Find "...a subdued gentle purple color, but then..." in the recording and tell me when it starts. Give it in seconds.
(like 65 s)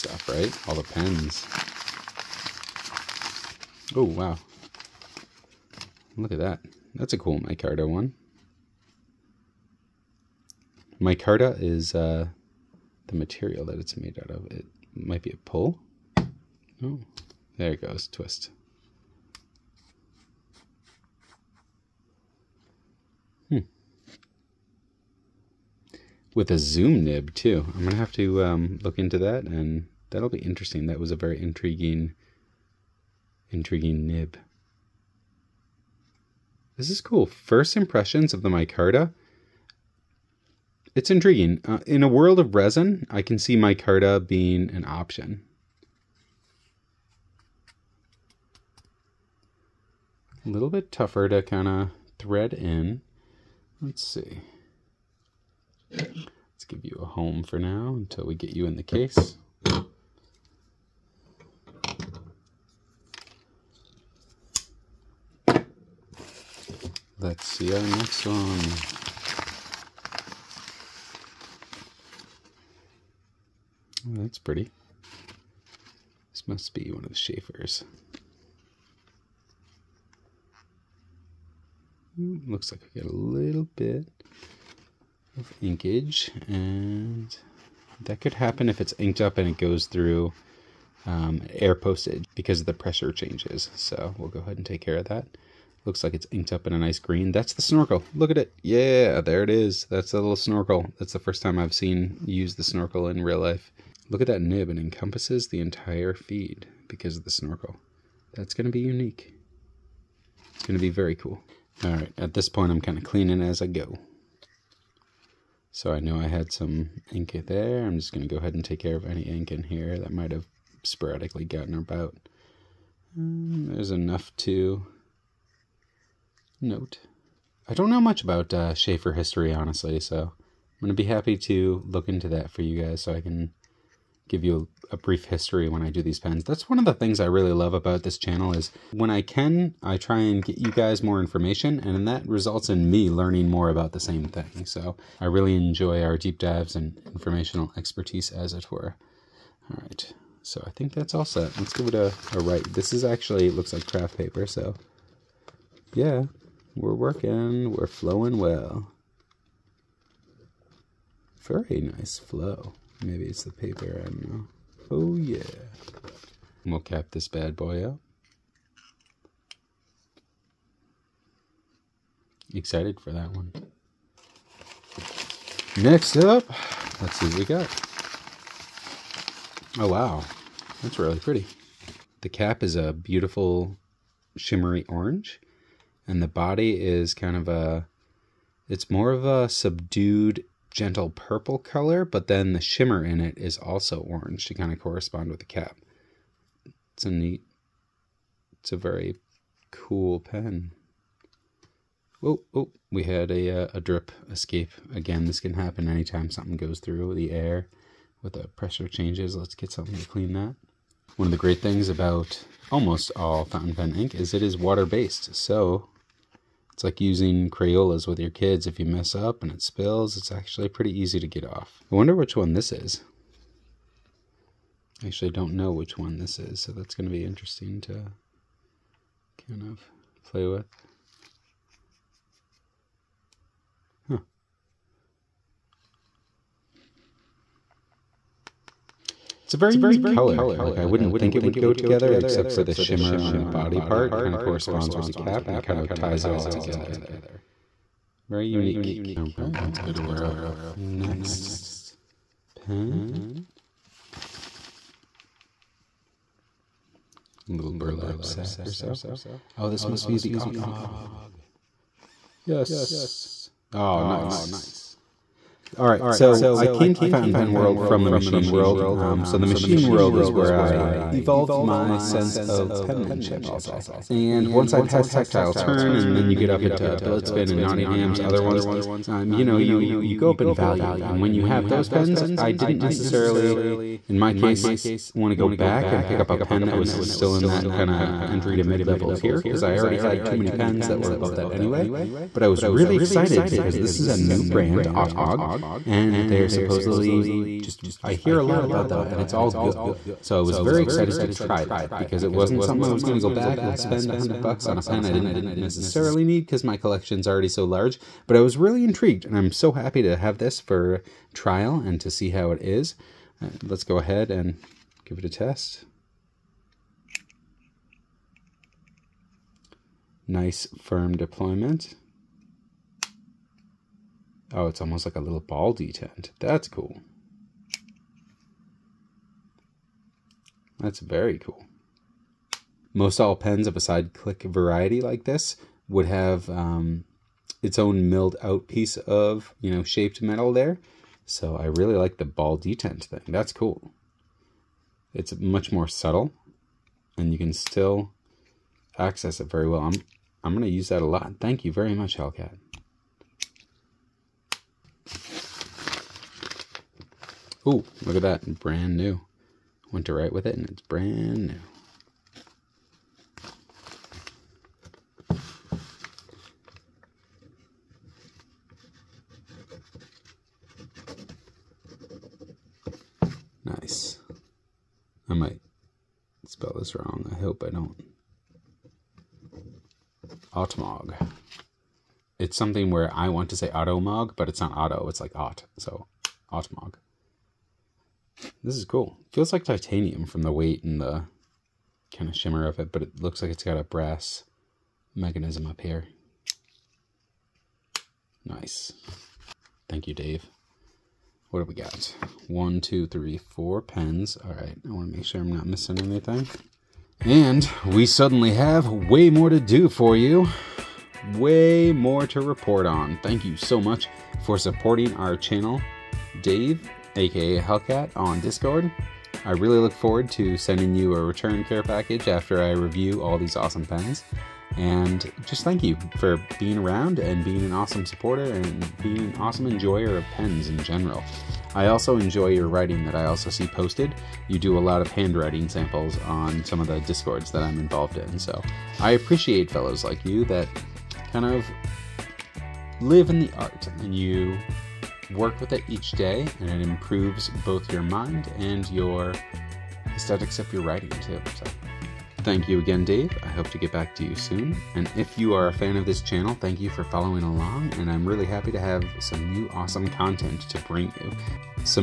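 189 s.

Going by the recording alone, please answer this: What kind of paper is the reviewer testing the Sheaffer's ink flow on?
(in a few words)
craft paper.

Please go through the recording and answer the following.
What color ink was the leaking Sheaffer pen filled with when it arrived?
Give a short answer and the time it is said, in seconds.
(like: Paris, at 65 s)
green, at 96 s.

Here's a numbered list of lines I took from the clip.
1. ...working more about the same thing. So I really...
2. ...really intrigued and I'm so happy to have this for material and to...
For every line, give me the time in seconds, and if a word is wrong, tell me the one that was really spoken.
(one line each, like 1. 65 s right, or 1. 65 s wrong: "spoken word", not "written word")
1. 143 s wrong: "learning", not "working"
2. 308 s wrong: "trial", not "material".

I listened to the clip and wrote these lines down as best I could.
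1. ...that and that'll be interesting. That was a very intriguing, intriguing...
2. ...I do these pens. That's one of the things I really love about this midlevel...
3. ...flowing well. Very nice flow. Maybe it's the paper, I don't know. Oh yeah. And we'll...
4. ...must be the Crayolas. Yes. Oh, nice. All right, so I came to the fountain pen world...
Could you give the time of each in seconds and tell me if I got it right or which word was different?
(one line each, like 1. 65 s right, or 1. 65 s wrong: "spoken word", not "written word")
1. 29 s right
2. 135 s wrong: "channel", not "midlevel"
3. 157 s right
4. 259 s wrong: "Otmog", not "Crayolas".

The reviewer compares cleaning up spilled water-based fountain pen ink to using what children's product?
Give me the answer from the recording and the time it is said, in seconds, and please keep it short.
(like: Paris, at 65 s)
Crayolas, at 217 s.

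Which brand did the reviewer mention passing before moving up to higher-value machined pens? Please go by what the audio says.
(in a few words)
Tactile Turn.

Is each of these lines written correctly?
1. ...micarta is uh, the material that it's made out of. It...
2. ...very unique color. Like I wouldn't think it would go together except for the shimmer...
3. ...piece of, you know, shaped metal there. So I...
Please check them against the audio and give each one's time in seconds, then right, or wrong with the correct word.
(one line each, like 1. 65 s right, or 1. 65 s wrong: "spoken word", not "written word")
1. 10 s right
2. 239 s right
3. 338 s right.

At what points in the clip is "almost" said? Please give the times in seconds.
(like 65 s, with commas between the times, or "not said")
212 s, 324 s.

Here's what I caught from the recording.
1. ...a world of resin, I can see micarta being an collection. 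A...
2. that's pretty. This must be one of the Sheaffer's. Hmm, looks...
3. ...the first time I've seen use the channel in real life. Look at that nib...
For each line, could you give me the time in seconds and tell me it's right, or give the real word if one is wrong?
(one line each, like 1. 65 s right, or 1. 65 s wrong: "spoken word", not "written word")
1. 42 s wrong: "option", not "collection"
2. 74 s right
3. 101 s wrong: "snorkel", not "channel".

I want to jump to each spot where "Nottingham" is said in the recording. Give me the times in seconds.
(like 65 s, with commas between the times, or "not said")
277 s.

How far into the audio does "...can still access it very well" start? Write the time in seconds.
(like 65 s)
347 s.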